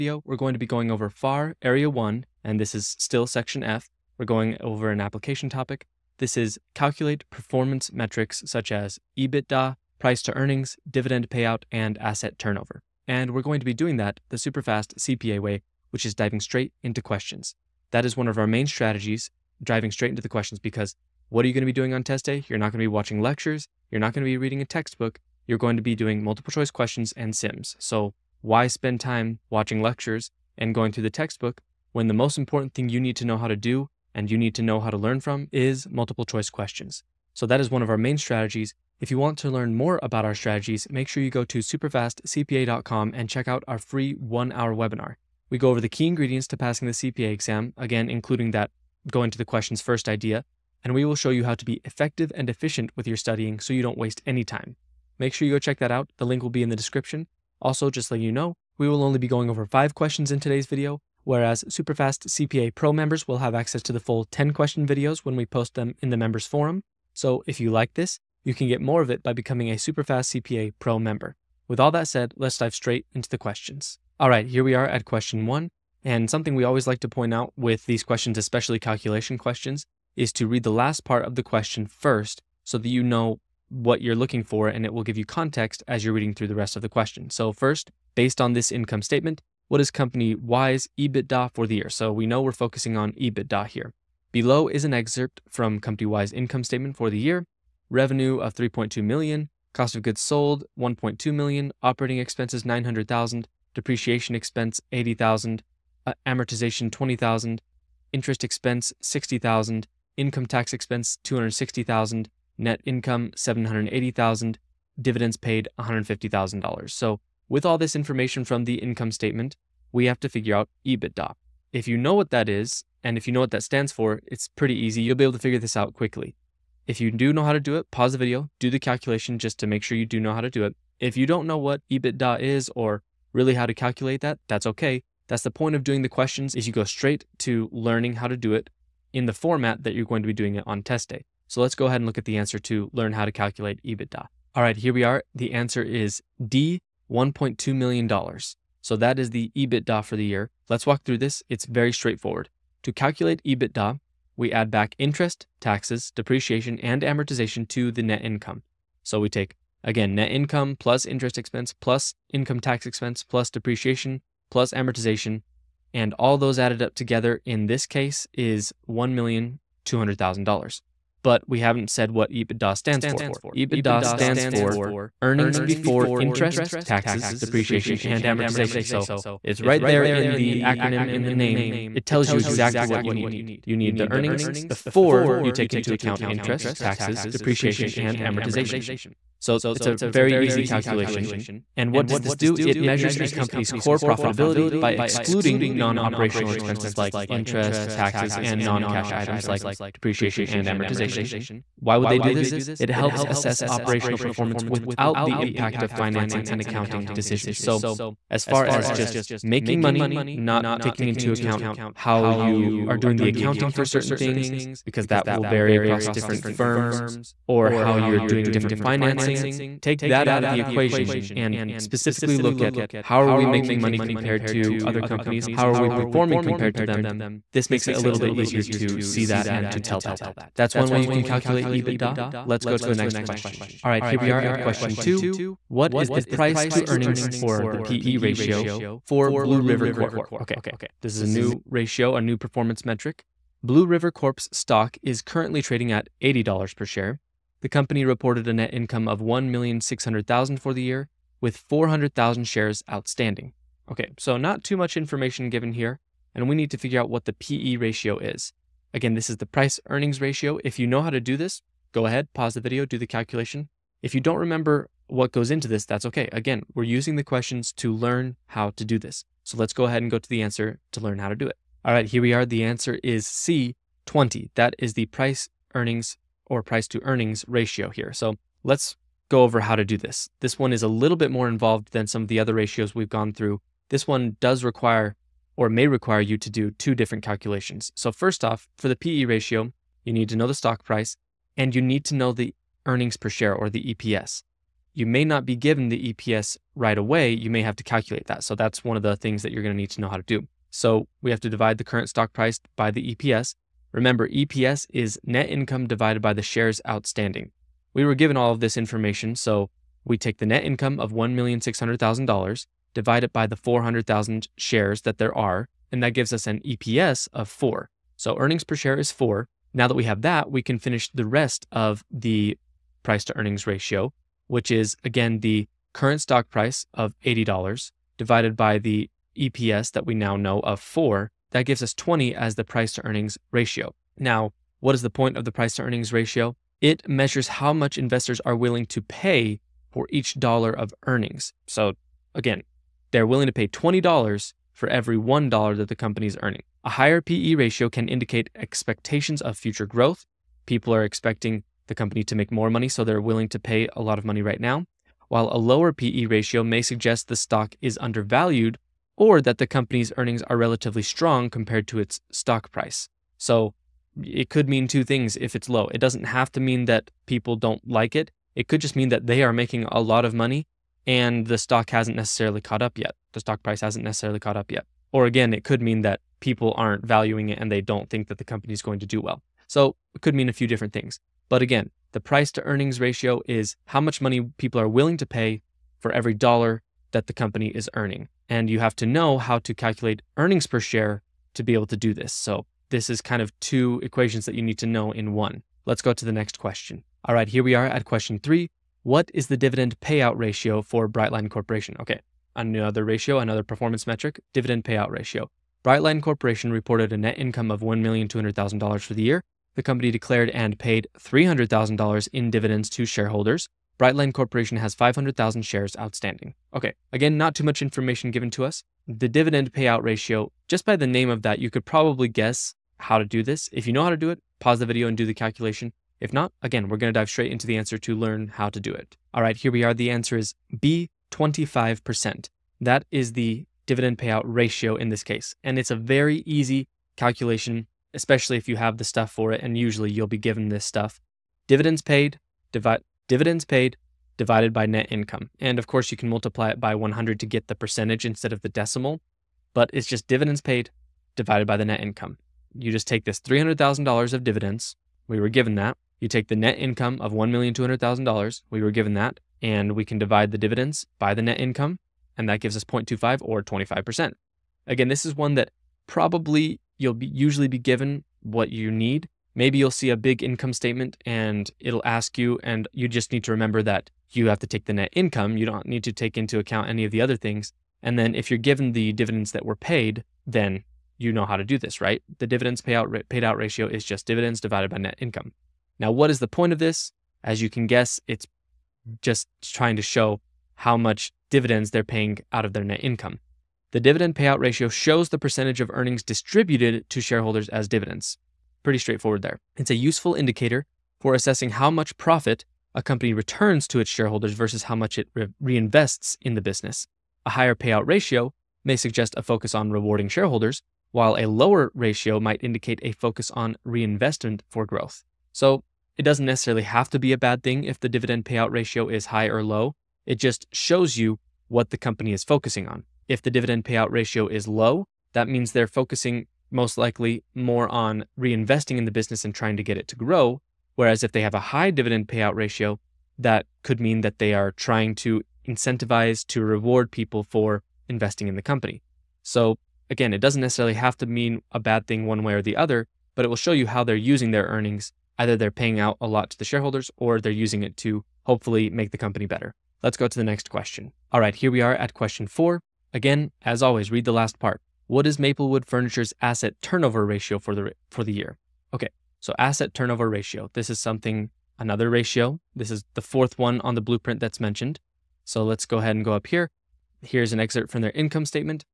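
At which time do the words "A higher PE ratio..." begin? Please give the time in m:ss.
5:46.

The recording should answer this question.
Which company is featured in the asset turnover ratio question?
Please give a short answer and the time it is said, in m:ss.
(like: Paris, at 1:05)
Maplewood Furniture, at 9:15.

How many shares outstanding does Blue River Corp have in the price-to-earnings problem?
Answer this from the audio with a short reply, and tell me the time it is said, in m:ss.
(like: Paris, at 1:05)
400,000, at 4:11.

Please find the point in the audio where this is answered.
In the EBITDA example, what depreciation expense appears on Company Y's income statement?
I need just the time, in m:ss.
1:44.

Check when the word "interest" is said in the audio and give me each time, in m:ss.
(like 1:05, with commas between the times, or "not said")
1:48, 2:34, 2:41, 2:56, 3:06, 3:17.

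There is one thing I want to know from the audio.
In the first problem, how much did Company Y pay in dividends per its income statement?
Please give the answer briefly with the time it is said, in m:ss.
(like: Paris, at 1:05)
$150,000, at 1:55.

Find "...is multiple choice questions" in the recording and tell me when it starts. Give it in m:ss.
0:35.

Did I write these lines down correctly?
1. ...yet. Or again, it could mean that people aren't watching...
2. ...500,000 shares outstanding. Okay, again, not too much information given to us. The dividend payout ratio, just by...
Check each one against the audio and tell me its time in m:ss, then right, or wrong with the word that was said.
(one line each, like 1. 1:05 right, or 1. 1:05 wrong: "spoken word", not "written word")
1. 6:14 wrong: "valuing", not "watching"
2. 6:54 right.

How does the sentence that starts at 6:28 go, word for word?
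And you have to know how to calculate earnings per share to be able to do this.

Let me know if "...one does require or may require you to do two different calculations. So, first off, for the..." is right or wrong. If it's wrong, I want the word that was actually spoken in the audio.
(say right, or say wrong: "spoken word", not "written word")
right.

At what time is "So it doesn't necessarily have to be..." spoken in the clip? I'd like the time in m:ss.
8:35.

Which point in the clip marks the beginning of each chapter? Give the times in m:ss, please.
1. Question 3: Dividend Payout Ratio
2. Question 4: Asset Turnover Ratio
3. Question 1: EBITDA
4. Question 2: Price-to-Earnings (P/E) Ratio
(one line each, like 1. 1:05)
1. 6:36
2. 9:10
3. 1:13
4. 3:53.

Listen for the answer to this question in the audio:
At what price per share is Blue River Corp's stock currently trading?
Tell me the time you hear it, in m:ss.
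4:06.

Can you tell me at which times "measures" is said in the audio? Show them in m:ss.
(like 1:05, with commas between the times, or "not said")
3:12, 5:37.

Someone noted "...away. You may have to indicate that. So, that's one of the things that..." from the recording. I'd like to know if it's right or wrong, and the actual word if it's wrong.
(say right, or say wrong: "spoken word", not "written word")
wrong: "calculate", not "indicate".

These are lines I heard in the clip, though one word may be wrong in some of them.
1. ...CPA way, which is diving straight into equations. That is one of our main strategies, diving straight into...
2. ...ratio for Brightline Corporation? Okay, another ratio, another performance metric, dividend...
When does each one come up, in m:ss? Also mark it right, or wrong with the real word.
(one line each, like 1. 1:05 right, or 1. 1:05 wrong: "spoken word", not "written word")
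1. 0:14 wrong: "questions", not "equations"
2. 6:40 right.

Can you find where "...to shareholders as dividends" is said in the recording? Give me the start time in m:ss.
8:17.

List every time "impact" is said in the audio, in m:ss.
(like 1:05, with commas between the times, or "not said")
3:25.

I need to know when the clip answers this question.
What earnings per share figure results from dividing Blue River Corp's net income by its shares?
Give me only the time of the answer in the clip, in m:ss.
5:16.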